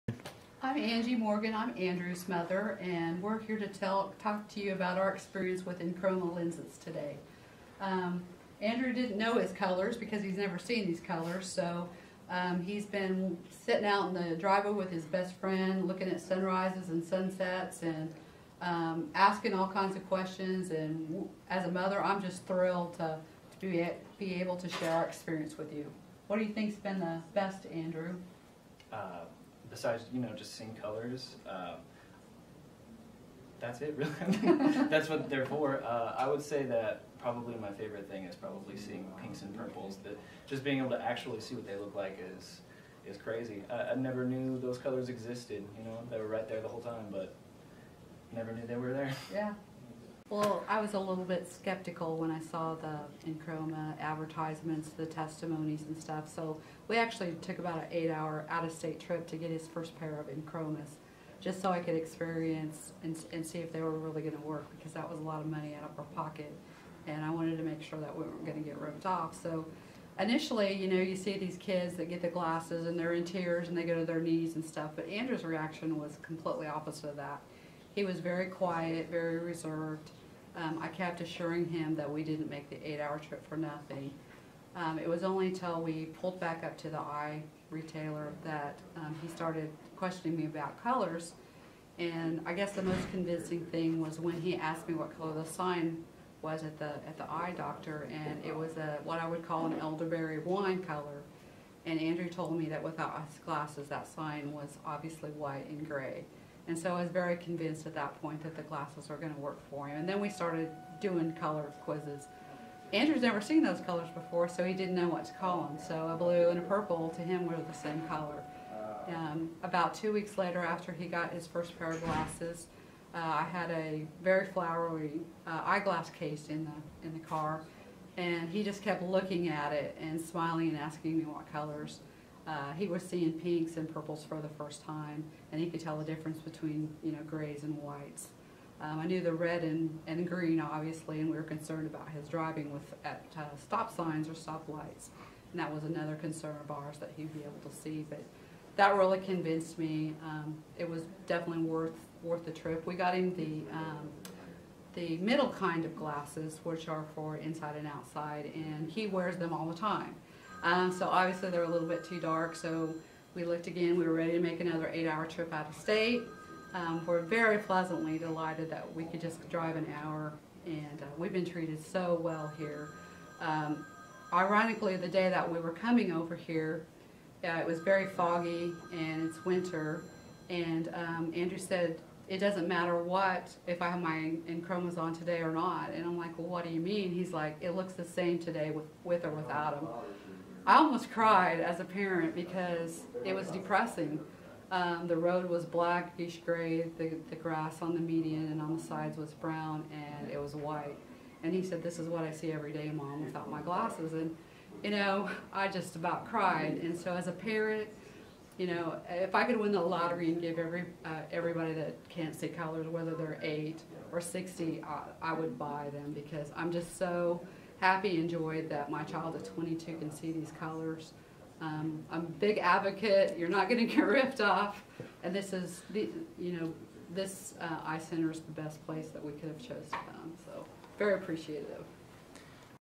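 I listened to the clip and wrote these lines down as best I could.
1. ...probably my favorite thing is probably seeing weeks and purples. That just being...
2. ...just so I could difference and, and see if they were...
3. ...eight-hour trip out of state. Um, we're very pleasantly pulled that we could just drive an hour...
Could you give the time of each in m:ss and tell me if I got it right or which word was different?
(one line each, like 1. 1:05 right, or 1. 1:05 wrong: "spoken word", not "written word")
1. 0:37 wrong: "pinks", not "weeks"
2. 1:01 wrong: "experience", not "difference"
3. 2:44 wrong: "delighted", not "pulled".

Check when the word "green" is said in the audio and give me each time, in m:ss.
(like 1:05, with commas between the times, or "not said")
2:20.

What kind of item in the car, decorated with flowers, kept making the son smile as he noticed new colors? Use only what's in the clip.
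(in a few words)
eyeglass case.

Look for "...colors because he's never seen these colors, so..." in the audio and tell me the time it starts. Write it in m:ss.
0:09.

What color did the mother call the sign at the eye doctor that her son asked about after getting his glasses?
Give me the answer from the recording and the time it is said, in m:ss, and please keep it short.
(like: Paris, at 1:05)
elderberry wine, at 1:39.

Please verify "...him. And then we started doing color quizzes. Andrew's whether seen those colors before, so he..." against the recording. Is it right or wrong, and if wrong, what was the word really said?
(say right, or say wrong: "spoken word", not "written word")
wrong: "never", not "whether".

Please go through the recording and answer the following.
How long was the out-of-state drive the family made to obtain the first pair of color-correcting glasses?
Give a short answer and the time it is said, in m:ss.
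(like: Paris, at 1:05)
8 hours, at 0:57.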